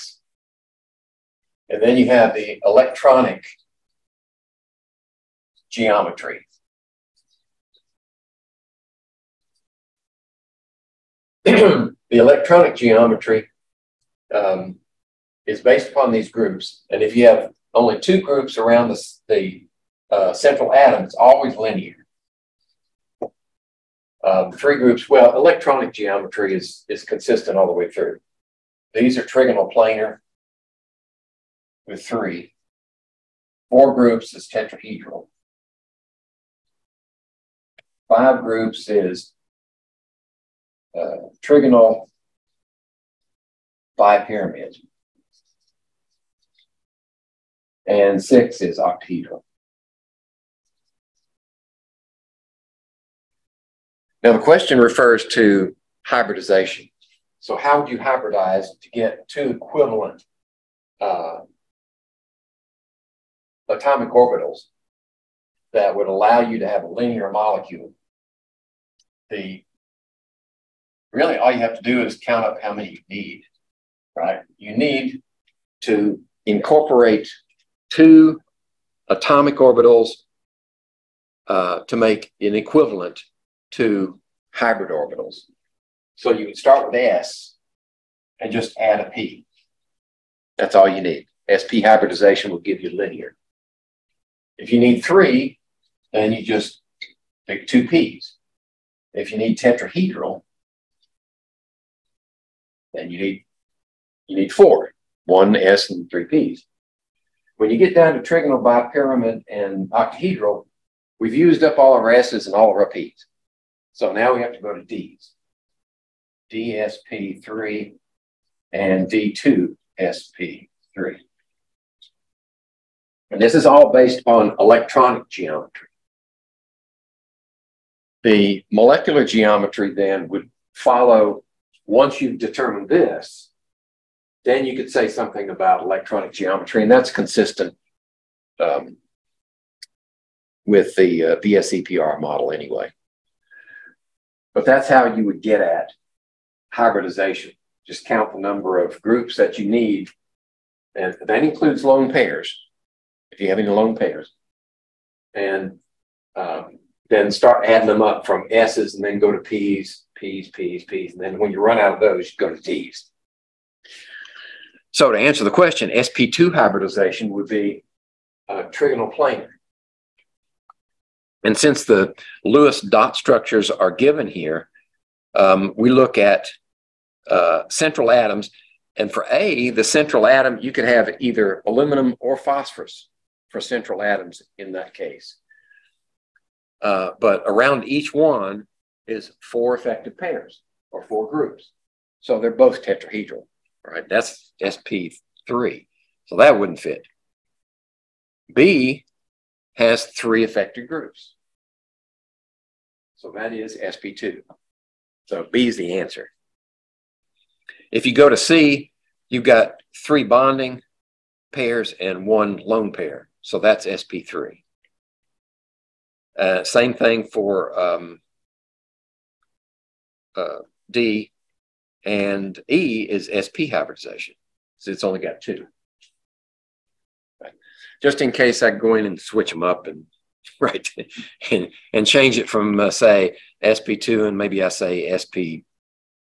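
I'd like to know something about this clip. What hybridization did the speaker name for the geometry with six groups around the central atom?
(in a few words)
D2SP3.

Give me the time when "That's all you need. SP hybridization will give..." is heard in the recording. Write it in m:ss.
1:30.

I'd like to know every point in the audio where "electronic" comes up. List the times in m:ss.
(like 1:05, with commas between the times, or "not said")
0:02, 0:12, 0:25, 2:04, 2:15.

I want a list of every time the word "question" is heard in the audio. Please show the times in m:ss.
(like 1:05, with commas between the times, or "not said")
0:54, 2:45.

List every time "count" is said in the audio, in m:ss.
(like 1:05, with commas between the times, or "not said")
1:12, 2:28.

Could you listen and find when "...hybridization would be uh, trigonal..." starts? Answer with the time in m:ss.
2:46.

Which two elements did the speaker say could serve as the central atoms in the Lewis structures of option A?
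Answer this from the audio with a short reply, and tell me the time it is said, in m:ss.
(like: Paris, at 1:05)
aluminum or phosphorus, at 3:01.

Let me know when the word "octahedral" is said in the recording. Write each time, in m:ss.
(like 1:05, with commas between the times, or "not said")
0:48, 1:49.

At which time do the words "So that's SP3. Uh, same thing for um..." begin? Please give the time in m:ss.
3:33.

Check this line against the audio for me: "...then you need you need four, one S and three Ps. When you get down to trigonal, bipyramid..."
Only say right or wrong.
right.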